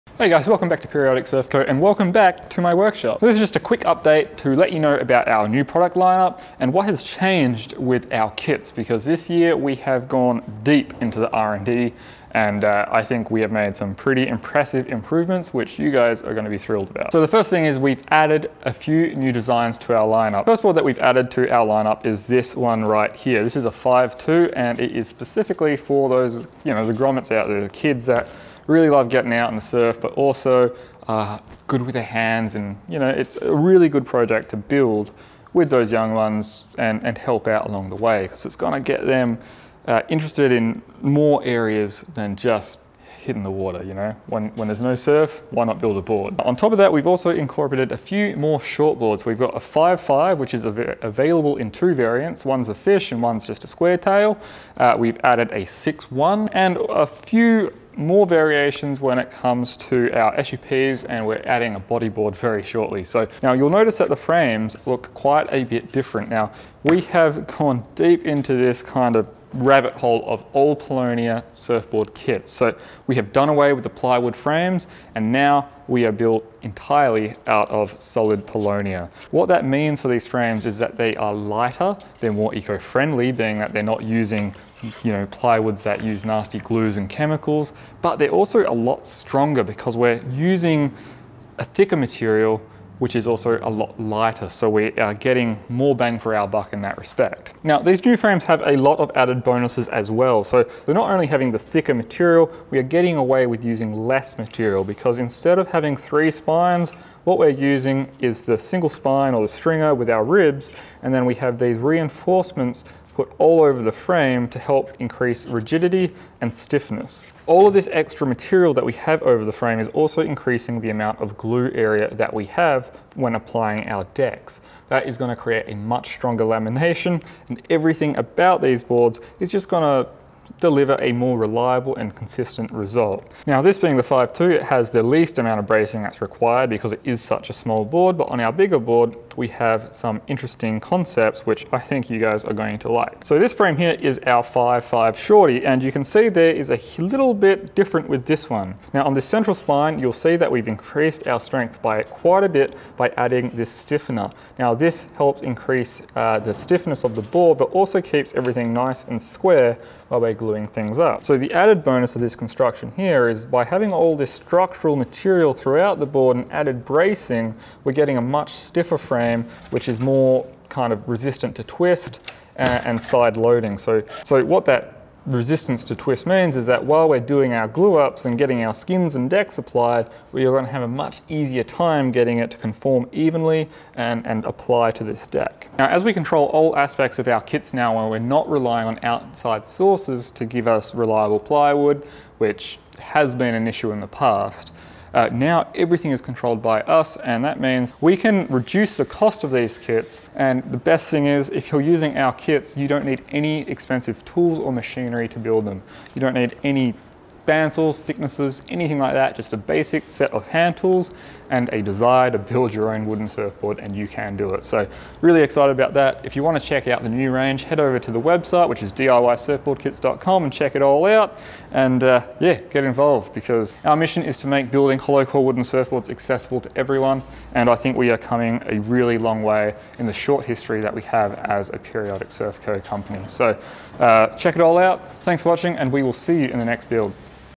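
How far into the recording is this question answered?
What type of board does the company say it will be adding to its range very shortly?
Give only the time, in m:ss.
1:01.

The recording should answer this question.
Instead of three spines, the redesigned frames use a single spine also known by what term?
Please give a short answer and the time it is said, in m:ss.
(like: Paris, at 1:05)
stringer, at 1:49.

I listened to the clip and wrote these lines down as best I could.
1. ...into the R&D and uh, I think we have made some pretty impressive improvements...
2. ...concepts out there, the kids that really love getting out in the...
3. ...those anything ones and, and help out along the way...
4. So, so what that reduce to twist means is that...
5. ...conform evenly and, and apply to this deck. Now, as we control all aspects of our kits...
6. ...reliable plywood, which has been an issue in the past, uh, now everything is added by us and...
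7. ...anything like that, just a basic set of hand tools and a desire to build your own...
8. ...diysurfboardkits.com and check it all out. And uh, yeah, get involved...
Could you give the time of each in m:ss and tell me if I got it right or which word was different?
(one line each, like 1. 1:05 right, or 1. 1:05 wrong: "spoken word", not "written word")
1. 0:11 right
2. 0:26 wrong: "grommets", not "concepts"
3. 0:35 wrong: "young", not "anything"
4. 2:53 wrong: "resistance", not "reduce"
5. 3:02 right
6. 3:10 wrong: "controlled", not "added"
7. 3:28 right
8. 3:38 right.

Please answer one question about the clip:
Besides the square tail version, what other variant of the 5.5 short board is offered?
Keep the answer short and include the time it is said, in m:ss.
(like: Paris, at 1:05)
fish, at 0:52.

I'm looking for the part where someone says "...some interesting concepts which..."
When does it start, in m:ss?
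2:19.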